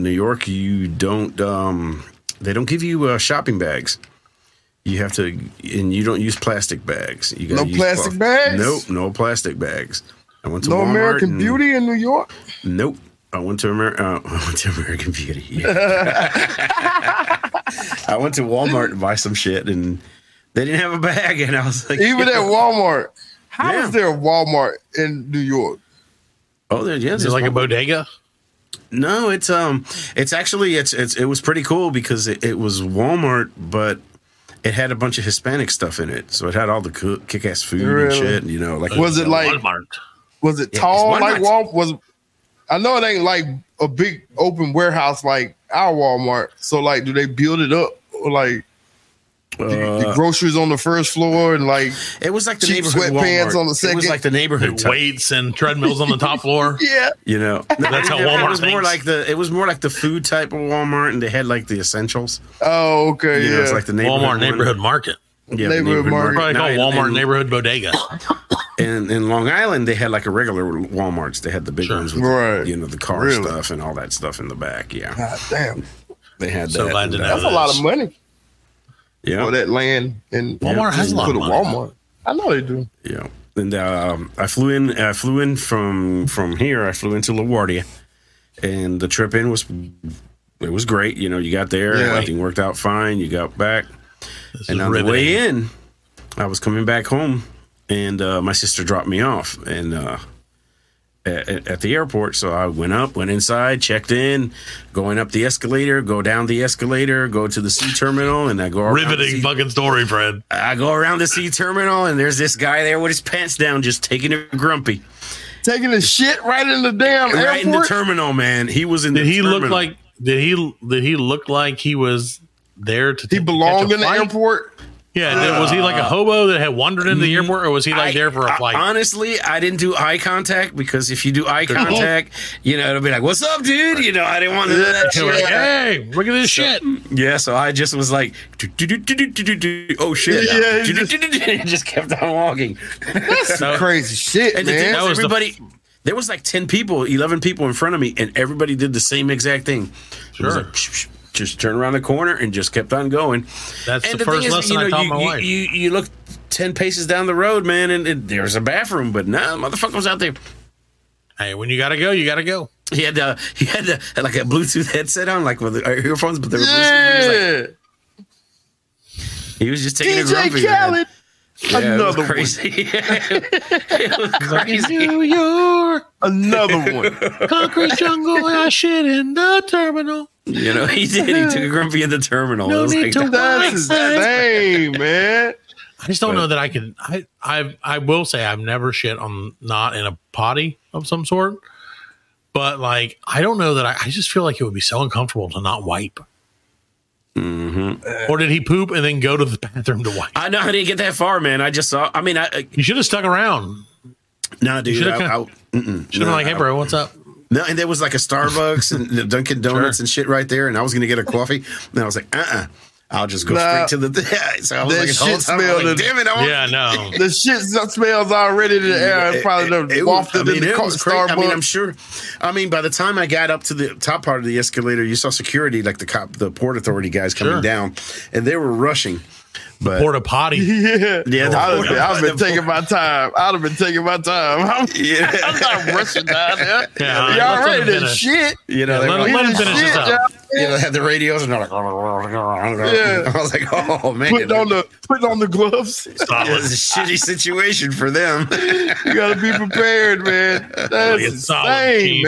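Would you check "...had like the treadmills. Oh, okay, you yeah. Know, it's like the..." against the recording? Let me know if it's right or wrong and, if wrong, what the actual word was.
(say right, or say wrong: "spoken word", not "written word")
wrong: "essentials", not "treadmills".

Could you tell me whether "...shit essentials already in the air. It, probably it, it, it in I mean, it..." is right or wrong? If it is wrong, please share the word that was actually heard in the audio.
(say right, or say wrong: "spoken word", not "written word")
wrong: "smells", not "essentials".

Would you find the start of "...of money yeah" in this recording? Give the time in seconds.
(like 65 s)
77 s.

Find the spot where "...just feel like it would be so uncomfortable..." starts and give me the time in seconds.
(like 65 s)
194 s.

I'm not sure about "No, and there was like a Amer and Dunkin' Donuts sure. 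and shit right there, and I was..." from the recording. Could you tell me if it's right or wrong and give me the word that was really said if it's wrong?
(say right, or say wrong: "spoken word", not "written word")
wrong: "Starbucks", not "Amer".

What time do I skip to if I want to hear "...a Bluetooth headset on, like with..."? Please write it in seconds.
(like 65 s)
164 s.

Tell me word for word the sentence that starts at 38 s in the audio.
You know, like was it like Walmart?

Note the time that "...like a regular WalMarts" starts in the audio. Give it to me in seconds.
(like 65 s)
70 s.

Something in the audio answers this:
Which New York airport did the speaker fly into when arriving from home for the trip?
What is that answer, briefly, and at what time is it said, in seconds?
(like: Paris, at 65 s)
LaGuardia, at 87 s.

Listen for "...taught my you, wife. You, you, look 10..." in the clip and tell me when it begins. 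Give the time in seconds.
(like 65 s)
154 s.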